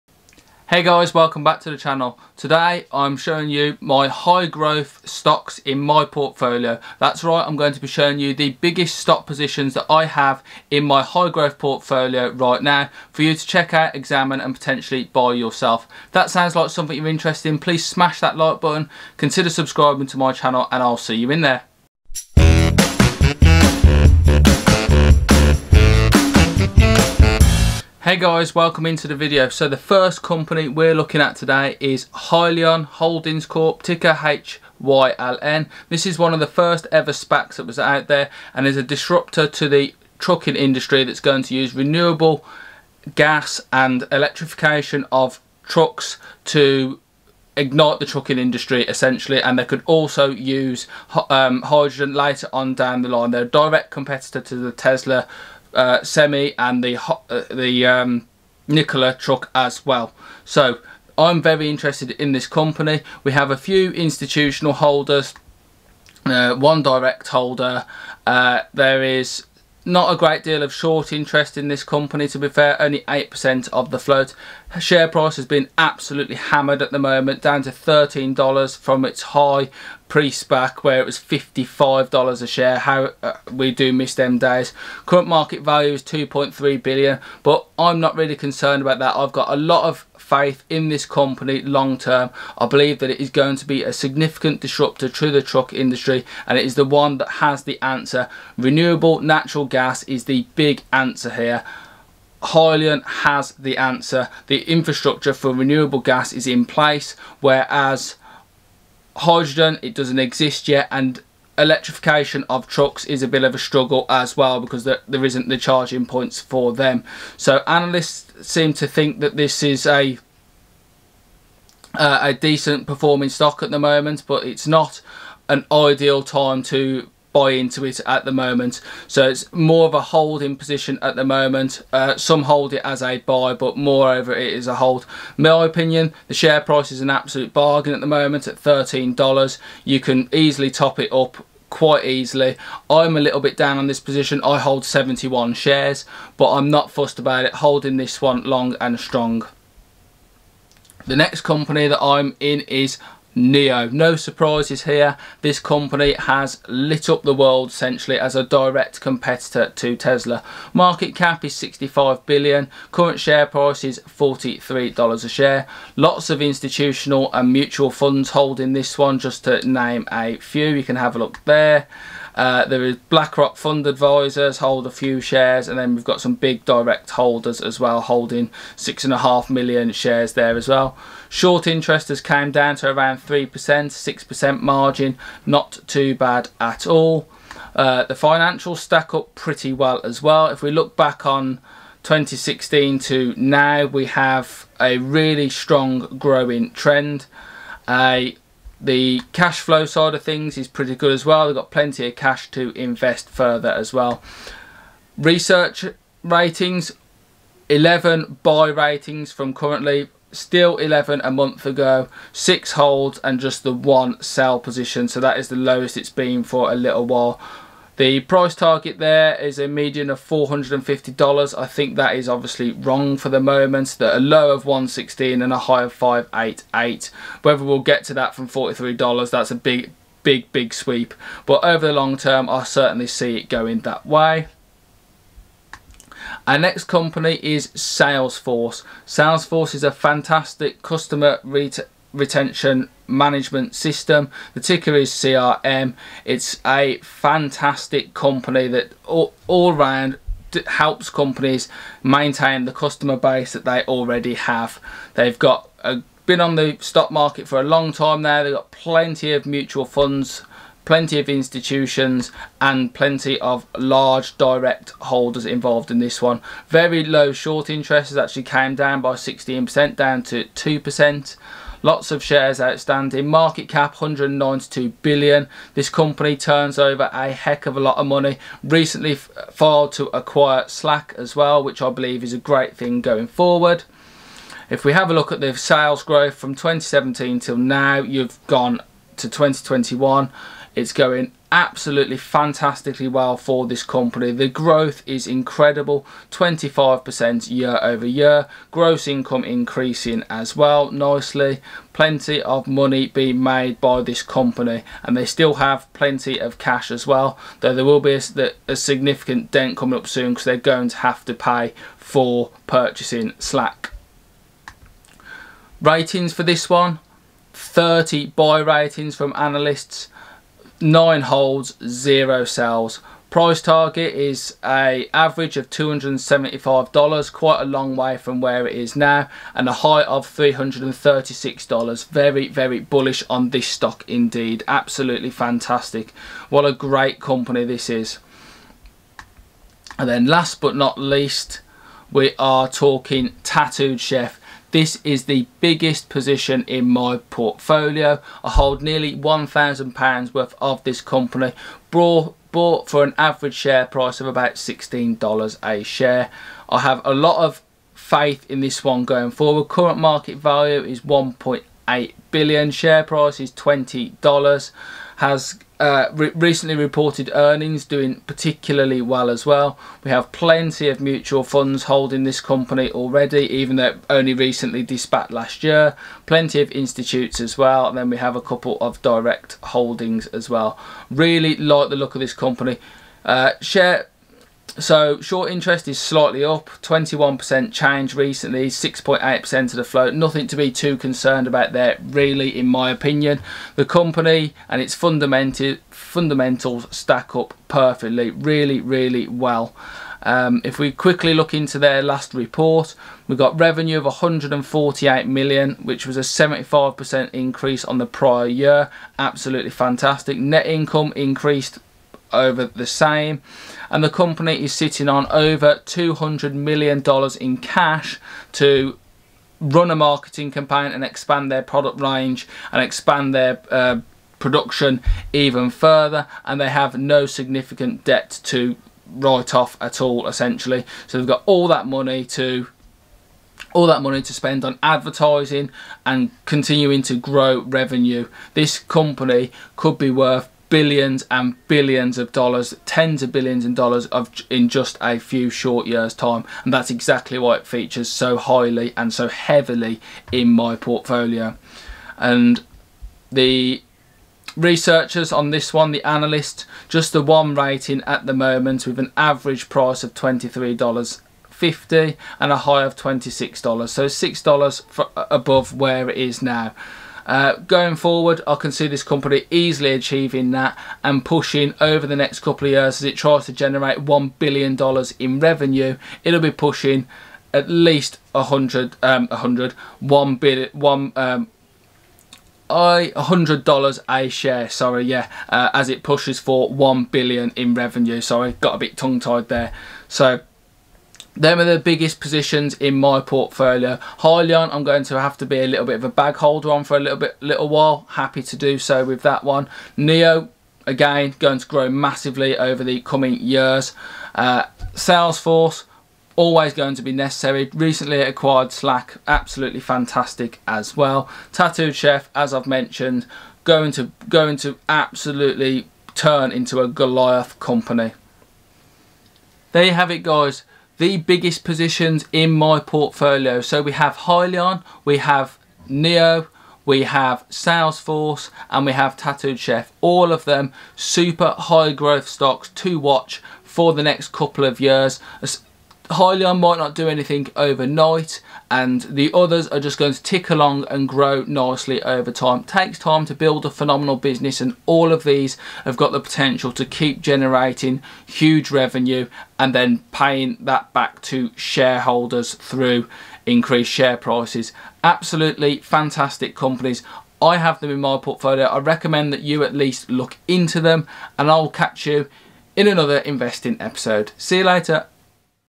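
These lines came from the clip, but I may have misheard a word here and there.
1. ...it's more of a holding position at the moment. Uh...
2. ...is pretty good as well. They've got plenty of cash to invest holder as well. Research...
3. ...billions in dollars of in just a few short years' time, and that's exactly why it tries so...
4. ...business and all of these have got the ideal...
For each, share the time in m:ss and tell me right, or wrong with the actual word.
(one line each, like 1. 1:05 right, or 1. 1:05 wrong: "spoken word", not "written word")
1. 2:09 right
2. 3:20 wrong: "further", not "holder"
3. 7:23 wrong: "features", not "tries"
4. 9:04 wrong: "potential", not "ideal".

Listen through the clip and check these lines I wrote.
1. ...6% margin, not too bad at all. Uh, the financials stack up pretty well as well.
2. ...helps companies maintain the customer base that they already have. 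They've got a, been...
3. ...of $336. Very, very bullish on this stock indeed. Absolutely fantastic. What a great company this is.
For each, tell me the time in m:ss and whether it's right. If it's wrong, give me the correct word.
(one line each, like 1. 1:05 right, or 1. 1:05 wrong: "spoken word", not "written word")
1. 3:03 right
2. 4:10 right
3. 5:30 right.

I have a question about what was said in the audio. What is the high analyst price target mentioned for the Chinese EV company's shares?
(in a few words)
588.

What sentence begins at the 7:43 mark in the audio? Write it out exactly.
So $6 above where it is now.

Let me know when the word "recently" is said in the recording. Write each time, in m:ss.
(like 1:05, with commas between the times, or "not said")
4:38, 6:06, 6:14, 6:28, 8:27.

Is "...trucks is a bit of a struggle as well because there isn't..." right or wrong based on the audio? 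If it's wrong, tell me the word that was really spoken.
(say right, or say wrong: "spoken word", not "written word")
right.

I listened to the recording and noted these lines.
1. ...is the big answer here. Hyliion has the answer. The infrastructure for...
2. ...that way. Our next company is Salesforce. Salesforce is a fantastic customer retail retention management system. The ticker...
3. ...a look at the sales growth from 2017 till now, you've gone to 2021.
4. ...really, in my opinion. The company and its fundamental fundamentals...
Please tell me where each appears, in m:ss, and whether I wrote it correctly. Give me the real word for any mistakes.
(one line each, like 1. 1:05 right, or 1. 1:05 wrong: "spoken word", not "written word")
1. 1:40 right
2. 3:53 right
3. 4:45 right
4. 6:32 right.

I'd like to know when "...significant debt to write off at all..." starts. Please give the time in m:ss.
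7:07.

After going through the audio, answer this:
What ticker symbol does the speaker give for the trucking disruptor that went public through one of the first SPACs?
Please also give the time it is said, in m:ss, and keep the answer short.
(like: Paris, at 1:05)
HYLN, at 0:34.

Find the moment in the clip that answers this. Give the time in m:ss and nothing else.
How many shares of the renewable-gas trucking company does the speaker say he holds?
2:24.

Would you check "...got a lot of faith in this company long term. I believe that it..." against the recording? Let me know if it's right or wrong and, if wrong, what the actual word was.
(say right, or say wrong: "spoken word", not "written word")
right.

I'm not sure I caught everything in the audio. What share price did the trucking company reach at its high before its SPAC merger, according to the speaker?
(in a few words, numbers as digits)
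$55.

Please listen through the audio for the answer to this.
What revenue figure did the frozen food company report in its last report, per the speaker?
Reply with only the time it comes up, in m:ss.
6:44.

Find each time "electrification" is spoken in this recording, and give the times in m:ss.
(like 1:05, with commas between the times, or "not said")
0:44, 1:51.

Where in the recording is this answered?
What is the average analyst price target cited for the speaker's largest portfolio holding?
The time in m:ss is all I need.
7:40.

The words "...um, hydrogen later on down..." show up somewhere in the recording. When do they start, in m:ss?
0:51.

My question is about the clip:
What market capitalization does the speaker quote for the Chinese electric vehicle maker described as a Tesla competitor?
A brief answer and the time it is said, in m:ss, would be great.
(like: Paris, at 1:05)
65 billion, at 2:41.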